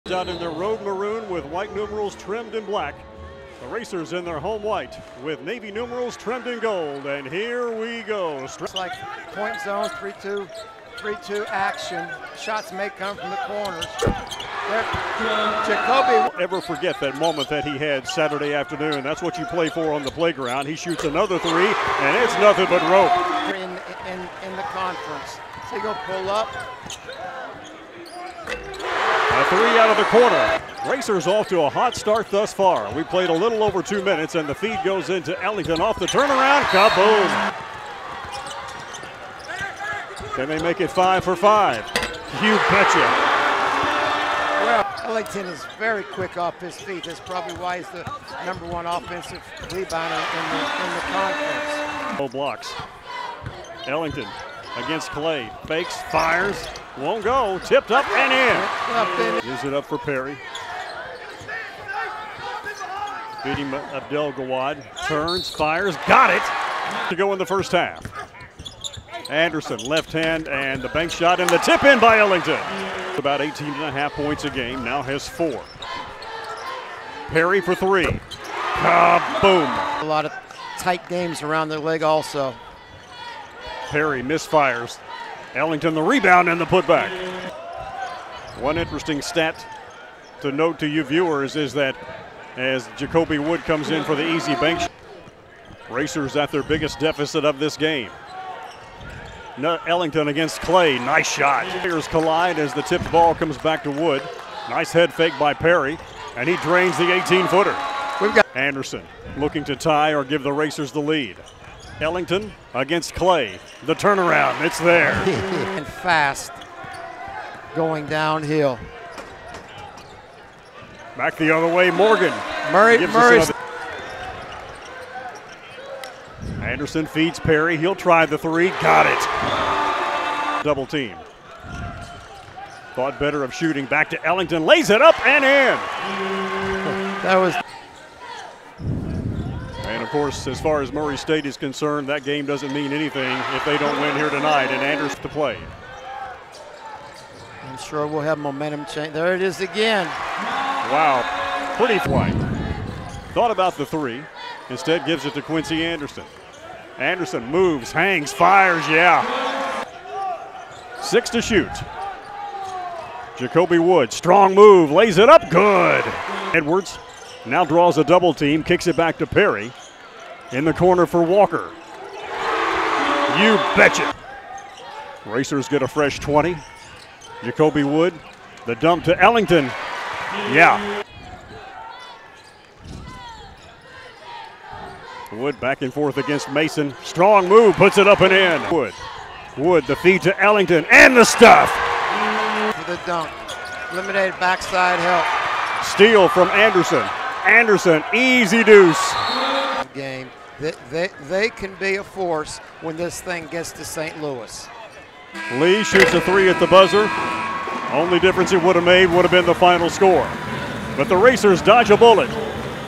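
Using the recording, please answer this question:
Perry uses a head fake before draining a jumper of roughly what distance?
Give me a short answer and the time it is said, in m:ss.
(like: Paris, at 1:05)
18 feet, at 1:47.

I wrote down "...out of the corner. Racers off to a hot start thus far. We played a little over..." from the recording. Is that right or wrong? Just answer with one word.
right.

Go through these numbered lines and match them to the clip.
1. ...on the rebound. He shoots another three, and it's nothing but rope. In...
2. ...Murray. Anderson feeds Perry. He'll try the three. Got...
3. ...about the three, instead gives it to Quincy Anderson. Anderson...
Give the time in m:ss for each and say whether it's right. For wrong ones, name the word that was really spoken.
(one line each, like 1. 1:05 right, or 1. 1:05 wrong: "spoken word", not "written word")
1. 0:19 wrong: "playground", not "rebound"
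2. 2:03 right
3. 2:33 right.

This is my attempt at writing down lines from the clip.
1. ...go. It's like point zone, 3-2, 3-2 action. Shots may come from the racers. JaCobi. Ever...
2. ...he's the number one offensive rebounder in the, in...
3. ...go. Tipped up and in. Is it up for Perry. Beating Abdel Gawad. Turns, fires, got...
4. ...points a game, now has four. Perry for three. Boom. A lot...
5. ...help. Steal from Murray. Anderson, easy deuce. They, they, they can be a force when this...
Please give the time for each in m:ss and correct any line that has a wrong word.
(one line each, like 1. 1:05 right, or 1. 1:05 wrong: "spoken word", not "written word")
1. 0:08 wrong: "corners", not "racers"
2. 0:47 right
3. 0:57 right
4. 1:14 right
5. 3:14 wrong: "Anderson", not "Murray".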